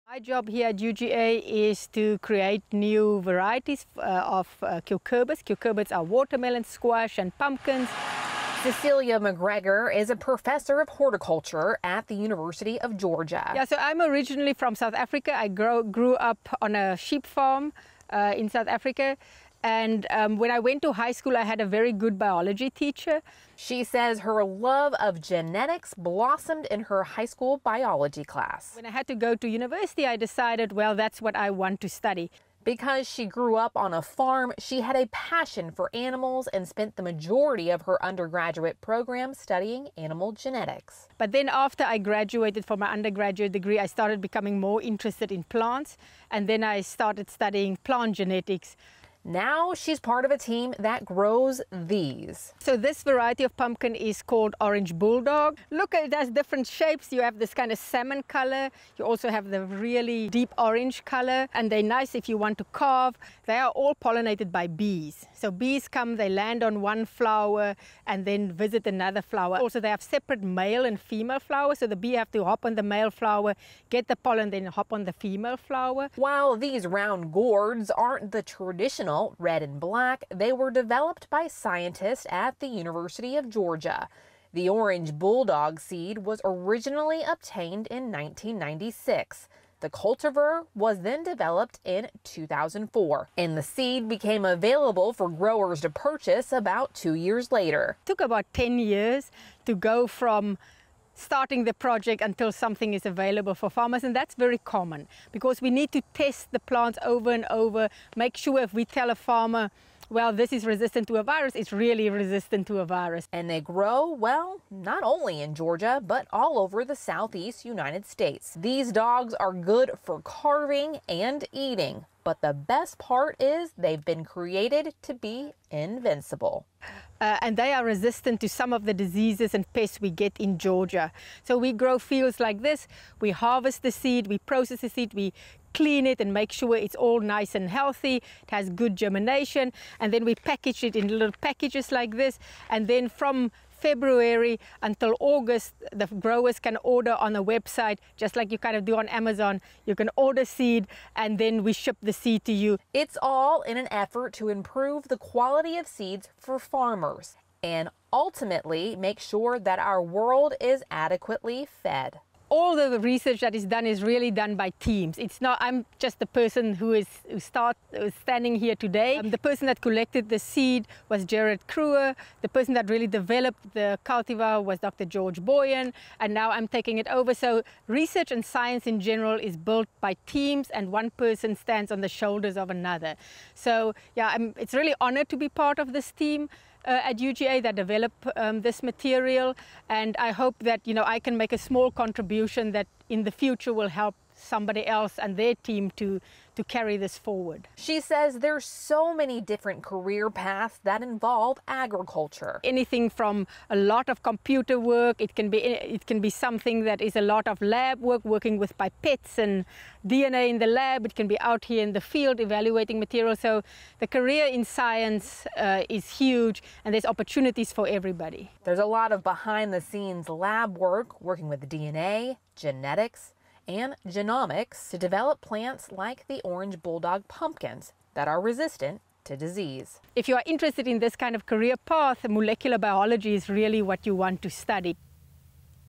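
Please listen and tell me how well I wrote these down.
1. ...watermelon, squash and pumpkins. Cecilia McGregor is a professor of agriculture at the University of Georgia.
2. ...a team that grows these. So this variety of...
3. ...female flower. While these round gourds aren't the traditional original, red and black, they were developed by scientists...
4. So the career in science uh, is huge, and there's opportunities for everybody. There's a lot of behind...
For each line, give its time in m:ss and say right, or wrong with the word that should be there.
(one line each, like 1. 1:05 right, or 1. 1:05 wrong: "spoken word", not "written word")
1. 0:06 wrong: "horticulture", not "agriculture"
2. 0:50 right
3. 1:15 right
4. 3:33 right.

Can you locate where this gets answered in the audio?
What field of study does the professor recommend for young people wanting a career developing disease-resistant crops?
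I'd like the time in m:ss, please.
3:52.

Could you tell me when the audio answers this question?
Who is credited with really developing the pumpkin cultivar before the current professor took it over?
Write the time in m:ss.
2:54.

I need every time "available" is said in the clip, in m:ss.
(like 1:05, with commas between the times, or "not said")
1:34, 1:43.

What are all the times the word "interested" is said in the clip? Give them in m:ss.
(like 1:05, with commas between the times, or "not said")
0:44, 3:50.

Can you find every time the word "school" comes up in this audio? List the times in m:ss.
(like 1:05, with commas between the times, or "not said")
0:21, 0:27.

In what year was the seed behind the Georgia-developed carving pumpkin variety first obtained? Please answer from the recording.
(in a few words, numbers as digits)
1996.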